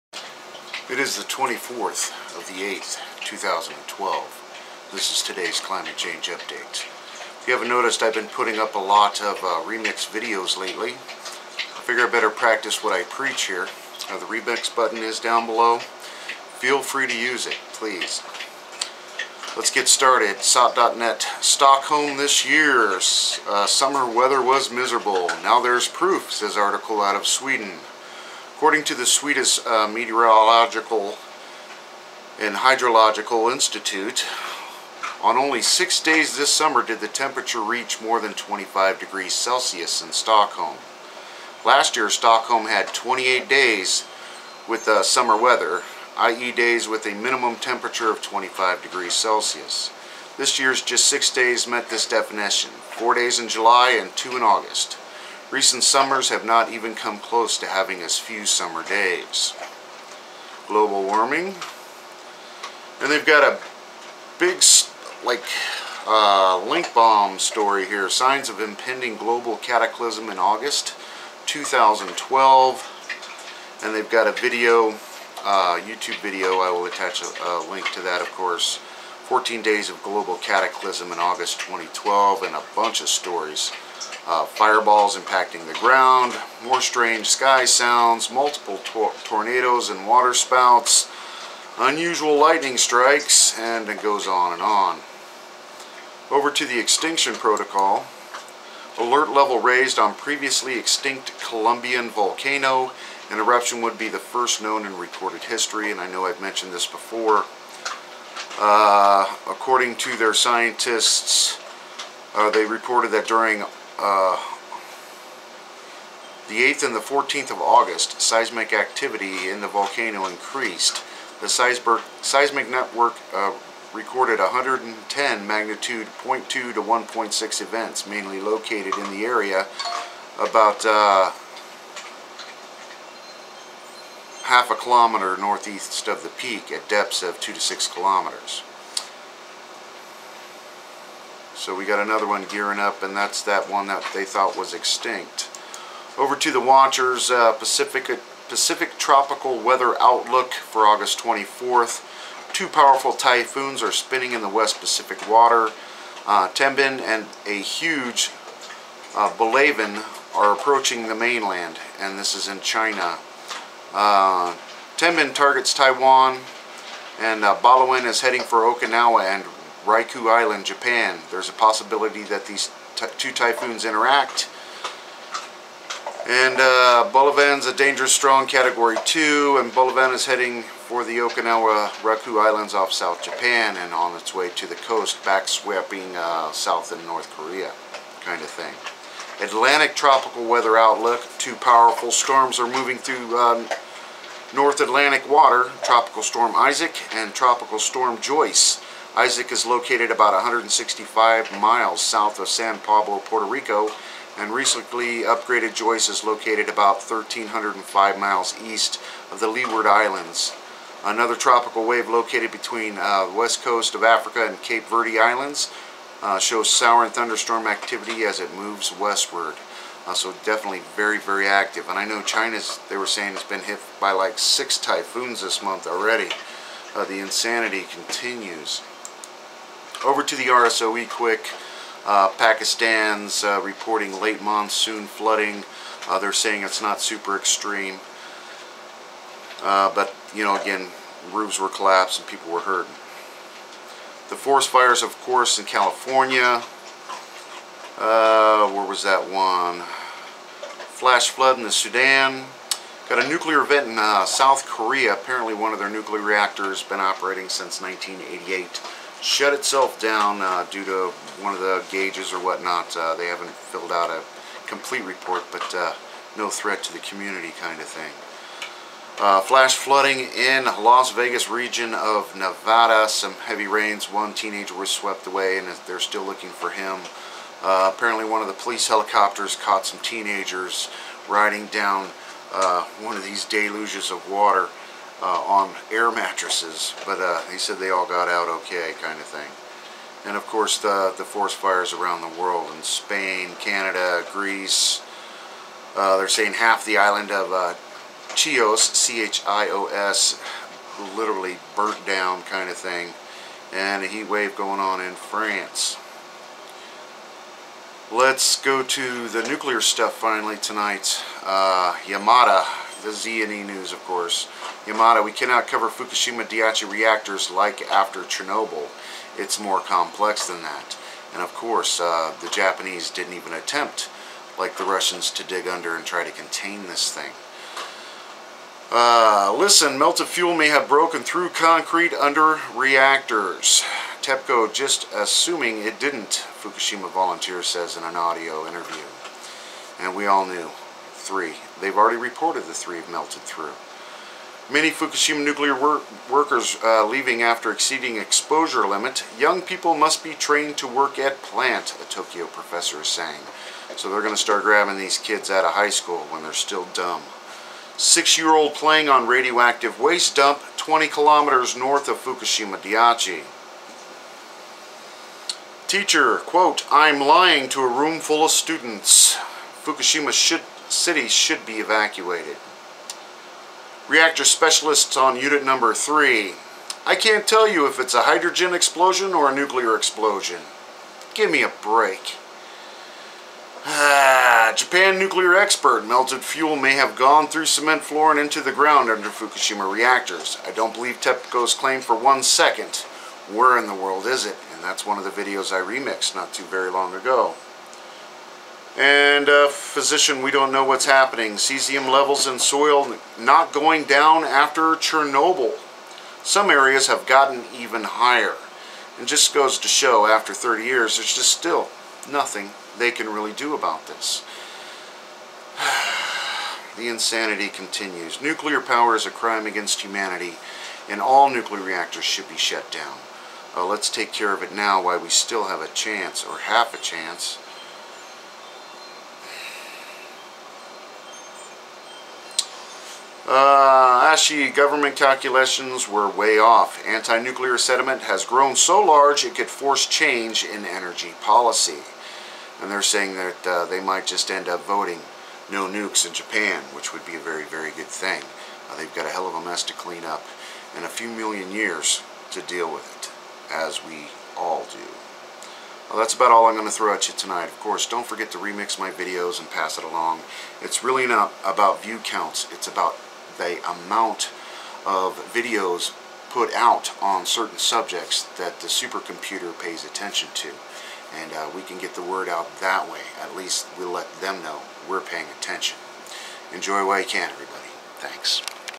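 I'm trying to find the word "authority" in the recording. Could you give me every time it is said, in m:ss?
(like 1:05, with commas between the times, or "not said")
not said.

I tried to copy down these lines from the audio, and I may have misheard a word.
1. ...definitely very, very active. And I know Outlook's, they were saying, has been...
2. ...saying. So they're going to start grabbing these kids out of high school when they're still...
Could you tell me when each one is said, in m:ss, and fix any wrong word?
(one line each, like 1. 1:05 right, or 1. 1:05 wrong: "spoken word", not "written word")
1. 3:40 wrong: "China", not "Outlook"
2. 5:53 right.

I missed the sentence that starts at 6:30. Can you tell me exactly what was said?
I don't believe TEPCO's claim for one second.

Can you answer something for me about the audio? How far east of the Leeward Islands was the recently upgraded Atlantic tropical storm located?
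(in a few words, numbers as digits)
1,305 miles.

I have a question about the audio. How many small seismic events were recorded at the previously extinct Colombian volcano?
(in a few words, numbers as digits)
110.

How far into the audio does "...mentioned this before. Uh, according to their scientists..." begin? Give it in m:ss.
1:46.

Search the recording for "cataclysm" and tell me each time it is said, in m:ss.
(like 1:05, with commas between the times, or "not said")
1:09, 1:20.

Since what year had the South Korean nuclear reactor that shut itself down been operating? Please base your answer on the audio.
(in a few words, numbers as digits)
1988.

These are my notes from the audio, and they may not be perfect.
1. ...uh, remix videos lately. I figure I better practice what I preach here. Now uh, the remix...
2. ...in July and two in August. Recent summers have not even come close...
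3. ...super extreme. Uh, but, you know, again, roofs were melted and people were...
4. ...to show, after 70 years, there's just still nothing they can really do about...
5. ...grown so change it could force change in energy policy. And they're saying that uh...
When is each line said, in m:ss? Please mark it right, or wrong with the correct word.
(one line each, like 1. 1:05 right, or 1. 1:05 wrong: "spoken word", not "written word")
1. 0:09 right
2. 0:53 right
3. 3:56 wrong: "collapsed", not "melted"
4. 6:49 wrong: "30", not "70"
5. 7:18 wrong: "large", not "change".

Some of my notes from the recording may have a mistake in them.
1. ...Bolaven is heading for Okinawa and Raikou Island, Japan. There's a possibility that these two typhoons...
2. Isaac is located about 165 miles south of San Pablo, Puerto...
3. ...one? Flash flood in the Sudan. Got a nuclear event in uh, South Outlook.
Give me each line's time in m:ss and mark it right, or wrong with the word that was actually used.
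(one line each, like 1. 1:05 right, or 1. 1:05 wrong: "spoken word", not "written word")
1. 2:47 right
2. 3:19 right
3. 4:09 wrong: "Korea", not "Outlook".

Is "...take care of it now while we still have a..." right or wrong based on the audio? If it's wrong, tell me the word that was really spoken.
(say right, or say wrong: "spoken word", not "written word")
right.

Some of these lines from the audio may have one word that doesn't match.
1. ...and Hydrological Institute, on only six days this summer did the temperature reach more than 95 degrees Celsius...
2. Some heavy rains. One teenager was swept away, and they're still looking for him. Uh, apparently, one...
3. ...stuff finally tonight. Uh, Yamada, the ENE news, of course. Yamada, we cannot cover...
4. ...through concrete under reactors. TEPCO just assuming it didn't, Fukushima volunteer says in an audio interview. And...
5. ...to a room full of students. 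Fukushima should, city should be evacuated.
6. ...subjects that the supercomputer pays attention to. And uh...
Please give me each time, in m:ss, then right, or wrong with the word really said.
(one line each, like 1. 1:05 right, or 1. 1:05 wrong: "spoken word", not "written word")
1. 0:32 wrong: "25", not "95"
2. 4:33 right
3. 5:09 right
4. 5:31 right
5. 6:07 right
6. 7:47 right.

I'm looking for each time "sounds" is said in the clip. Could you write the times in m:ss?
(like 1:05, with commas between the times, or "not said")
1:27.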